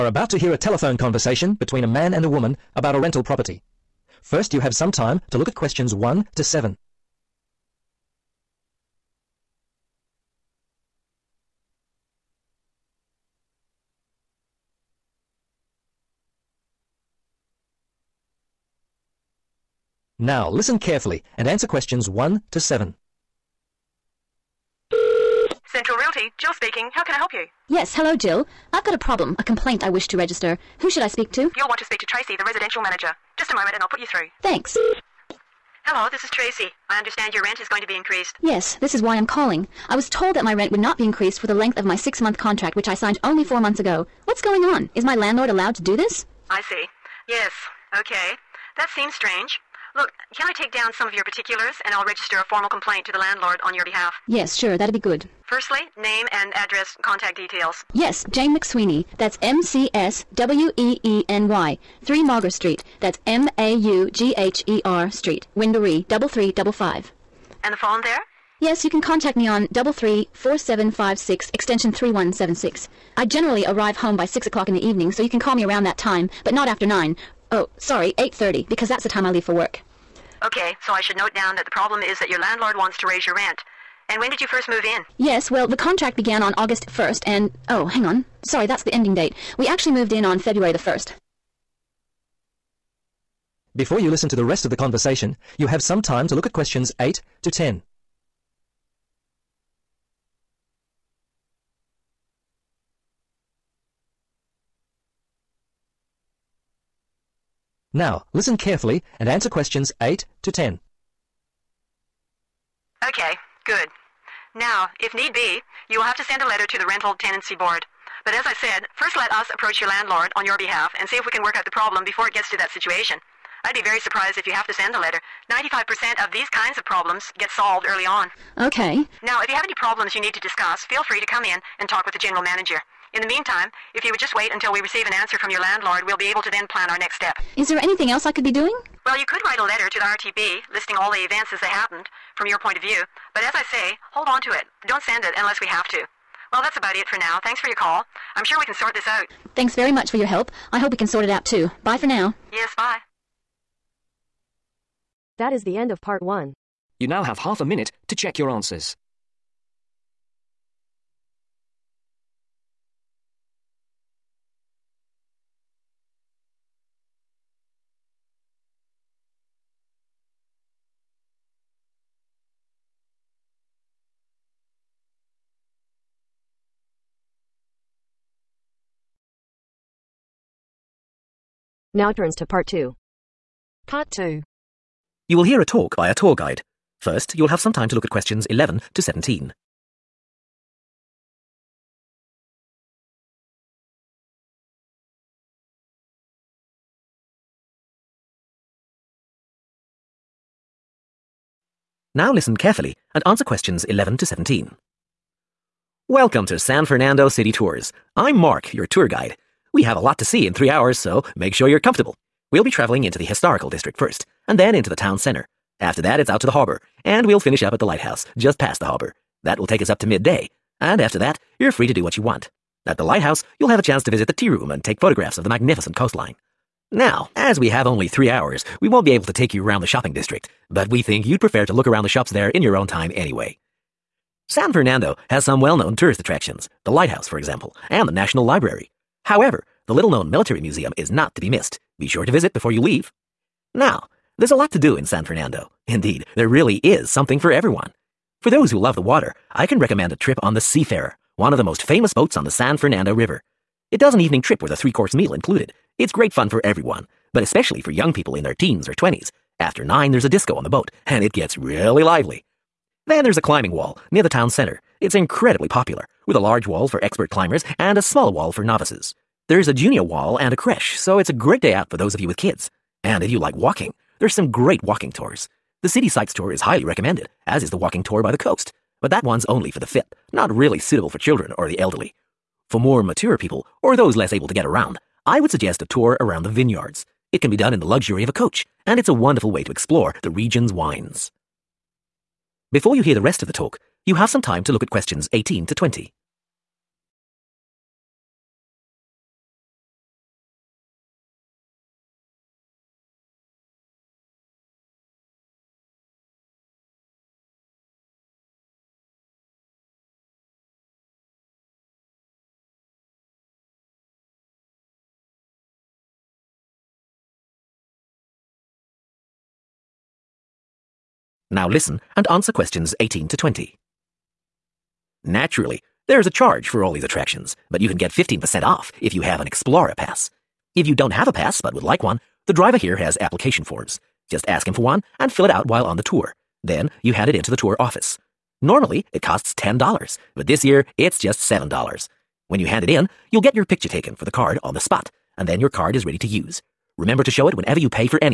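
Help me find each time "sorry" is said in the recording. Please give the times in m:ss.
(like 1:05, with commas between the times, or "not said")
1:17, 1:28.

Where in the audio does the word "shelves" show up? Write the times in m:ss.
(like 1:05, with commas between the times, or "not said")
not said.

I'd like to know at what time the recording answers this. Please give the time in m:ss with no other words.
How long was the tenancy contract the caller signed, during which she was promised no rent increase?
0:41.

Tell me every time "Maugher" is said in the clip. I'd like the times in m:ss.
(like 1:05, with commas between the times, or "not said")
1:02.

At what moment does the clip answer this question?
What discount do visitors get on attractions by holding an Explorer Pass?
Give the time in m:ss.
5:28.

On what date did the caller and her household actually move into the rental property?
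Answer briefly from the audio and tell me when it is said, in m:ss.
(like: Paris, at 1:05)
February 1st, at 1:30.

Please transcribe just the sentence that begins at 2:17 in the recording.
Is there anything else I could be doing?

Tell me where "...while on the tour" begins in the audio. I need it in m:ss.
5:35.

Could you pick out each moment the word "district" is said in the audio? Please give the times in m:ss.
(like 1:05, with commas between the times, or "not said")
3:33, 3:50.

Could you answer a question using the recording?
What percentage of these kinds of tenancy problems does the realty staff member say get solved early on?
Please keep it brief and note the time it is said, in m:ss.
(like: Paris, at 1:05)
95%, at 2:05.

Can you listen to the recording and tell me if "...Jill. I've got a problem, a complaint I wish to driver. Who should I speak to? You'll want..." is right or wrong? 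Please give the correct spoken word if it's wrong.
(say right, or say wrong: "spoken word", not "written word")
wrong: "register", not "driver".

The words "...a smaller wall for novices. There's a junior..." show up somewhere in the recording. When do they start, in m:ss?
4:27.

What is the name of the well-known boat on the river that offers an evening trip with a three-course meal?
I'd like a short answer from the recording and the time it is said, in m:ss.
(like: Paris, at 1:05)
Seafarer, at 4:10.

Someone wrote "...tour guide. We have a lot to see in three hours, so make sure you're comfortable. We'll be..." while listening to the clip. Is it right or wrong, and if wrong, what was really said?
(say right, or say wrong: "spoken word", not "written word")
right.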